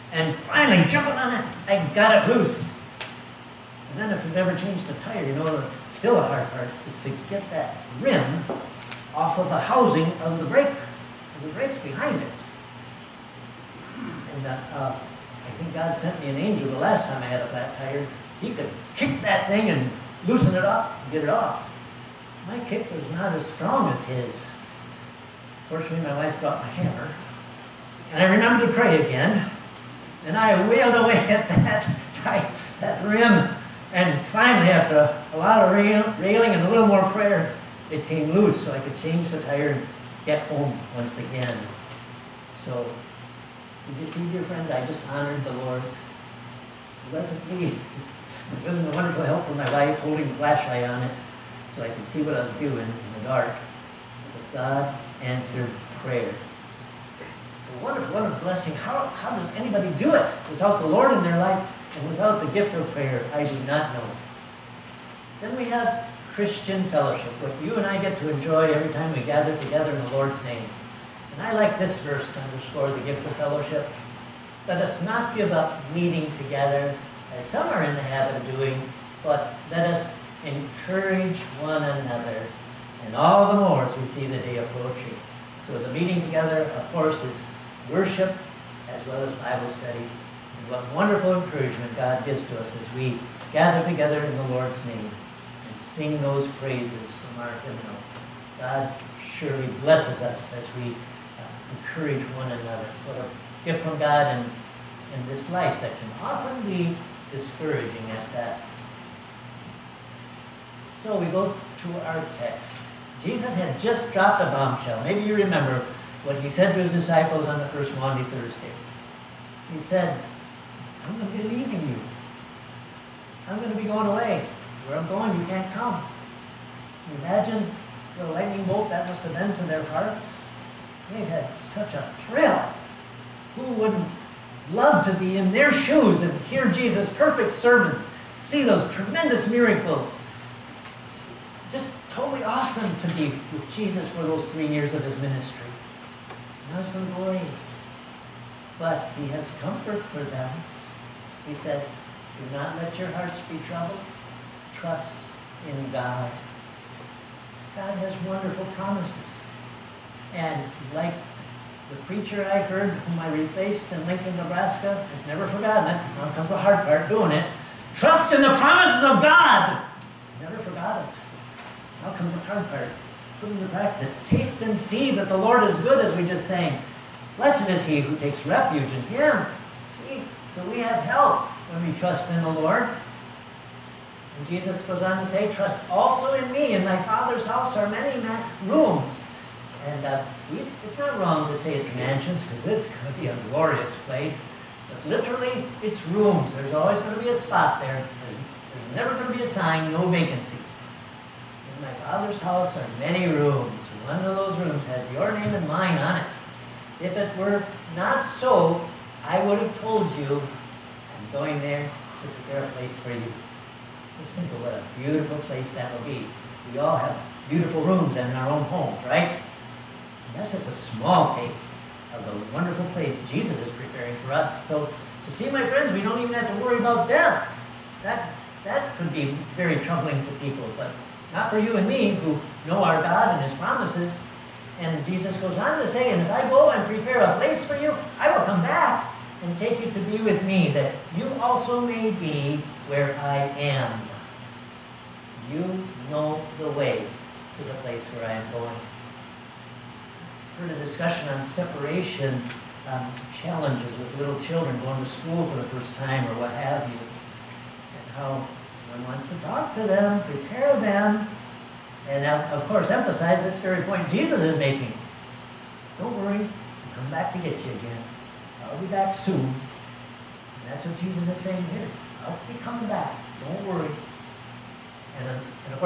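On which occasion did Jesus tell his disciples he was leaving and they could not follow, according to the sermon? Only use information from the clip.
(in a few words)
The first Maundy Thursday.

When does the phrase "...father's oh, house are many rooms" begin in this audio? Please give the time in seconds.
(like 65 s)
202 s.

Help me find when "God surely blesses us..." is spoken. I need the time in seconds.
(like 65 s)
98 s.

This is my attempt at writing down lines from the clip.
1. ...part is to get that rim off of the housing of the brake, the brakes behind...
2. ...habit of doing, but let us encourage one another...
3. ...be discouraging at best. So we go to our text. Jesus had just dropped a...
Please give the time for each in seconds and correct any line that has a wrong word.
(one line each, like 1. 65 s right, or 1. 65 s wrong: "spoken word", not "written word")
1. 6 s right
2. 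78 s right
3. 106 s right.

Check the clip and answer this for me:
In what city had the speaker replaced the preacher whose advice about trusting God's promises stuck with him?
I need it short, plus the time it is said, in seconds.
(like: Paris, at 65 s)
Lincoln, Nebraska, at 164 s.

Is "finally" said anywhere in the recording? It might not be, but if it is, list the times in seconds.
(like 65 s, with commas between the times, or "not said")
0 s, 34 s.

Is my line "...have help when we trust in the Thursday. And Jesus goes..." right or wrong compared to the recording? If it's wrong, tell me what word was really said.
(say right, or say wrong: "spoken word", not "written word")
wrong: "Lord", not "Thursday".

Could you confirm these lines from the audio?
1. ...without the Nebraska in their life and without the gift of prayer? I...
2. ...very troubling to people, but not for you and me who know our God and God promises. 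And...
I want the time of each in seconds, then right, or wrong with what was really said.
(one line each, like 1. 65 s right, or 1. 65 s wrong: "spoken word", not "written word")
1. 60 s wrong: "Lord", not "Nebraska"
2. 229 s wrong: "His", not "God".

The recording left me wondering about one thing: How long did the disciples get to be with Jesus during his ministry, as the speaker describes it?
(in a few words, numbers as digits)
3 years.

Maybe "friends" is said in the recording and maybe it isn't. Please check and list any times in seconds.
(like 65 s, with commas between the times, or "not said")
44 s, 225 s.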